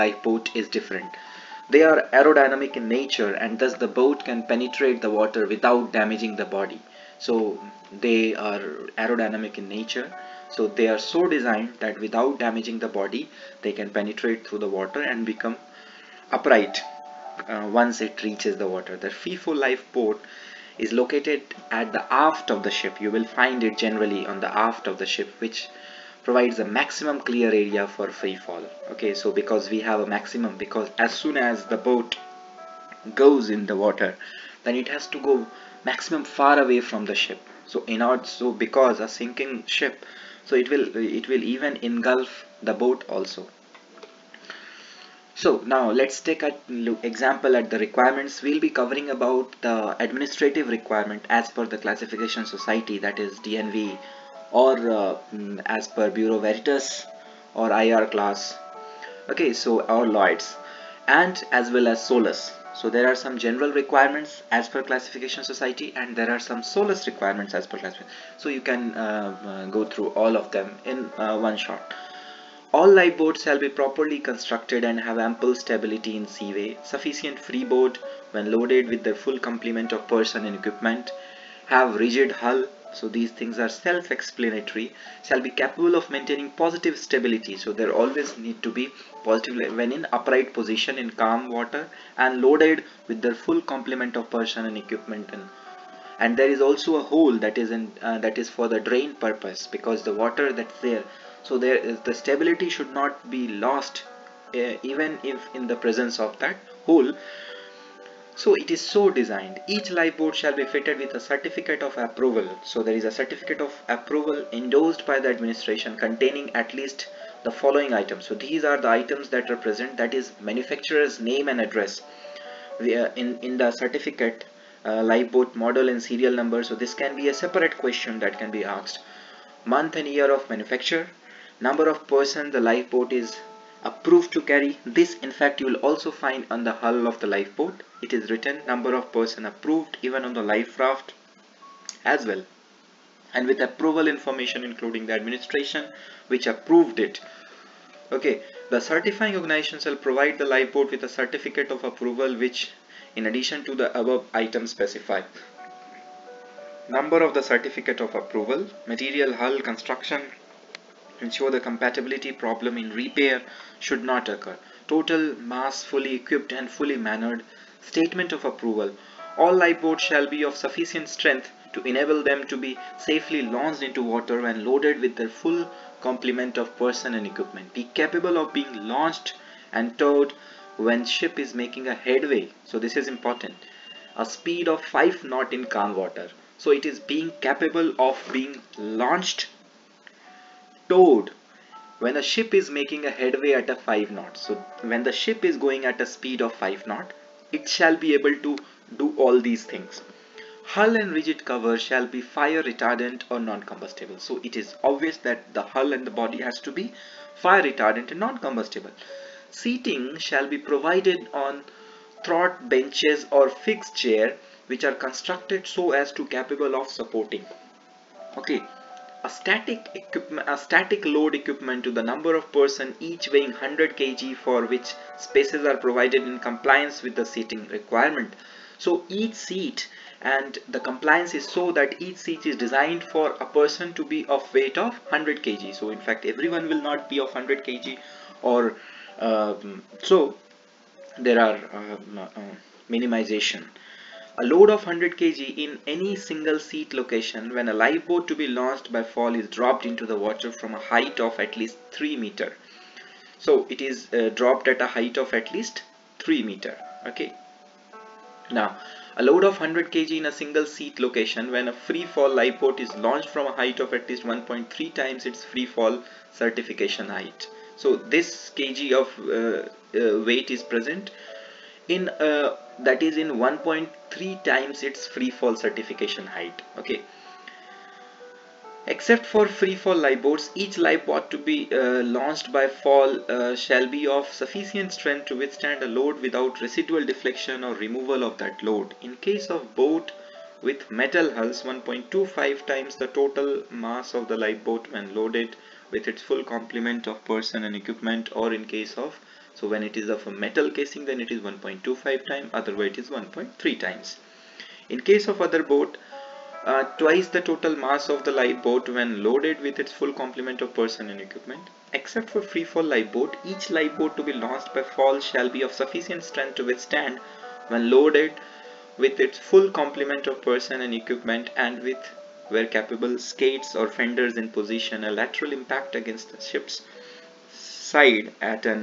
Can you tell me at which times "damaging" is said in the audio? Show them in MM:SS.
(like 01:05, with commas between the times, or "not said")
00:05, 00:12.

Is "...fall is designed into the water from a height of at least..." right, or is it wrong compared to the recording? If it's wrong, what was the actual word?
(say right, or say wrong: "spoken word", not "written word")
wrong: "dropped", not "designed".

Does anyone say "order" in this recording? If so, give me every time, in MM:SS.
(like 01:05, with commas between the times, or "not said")
00:38.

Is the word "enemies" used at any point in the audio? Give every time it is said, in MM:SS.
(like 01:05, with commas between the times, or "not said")
not said.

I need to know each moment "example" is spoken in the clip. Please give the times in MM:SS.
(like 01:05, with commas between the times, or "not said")
00:47.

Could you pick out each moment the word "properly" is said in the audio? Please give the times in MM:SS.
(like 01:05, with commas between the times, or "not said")
01:13.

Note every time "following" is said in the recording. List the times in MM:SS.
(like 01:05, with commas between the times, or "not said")
01:57.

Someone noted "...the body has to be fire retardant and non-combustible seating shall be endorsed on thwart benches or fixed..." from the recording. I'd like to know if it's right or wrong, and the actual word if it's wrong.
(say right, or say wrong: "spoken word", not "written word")
wrong: "provided", not "endorsed".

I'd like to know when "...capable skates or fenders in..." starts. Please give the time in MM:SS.
05:22.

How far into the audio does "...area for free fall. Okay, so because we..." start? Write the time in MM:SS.
00:27.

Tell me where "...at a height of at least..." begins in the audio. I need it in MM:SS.
04:14.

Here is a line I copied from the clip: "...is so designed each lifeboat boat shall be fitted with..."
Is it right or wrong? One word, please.
right.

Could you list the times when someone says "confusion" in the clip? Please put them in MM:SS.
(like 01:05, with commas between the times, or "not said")
not said.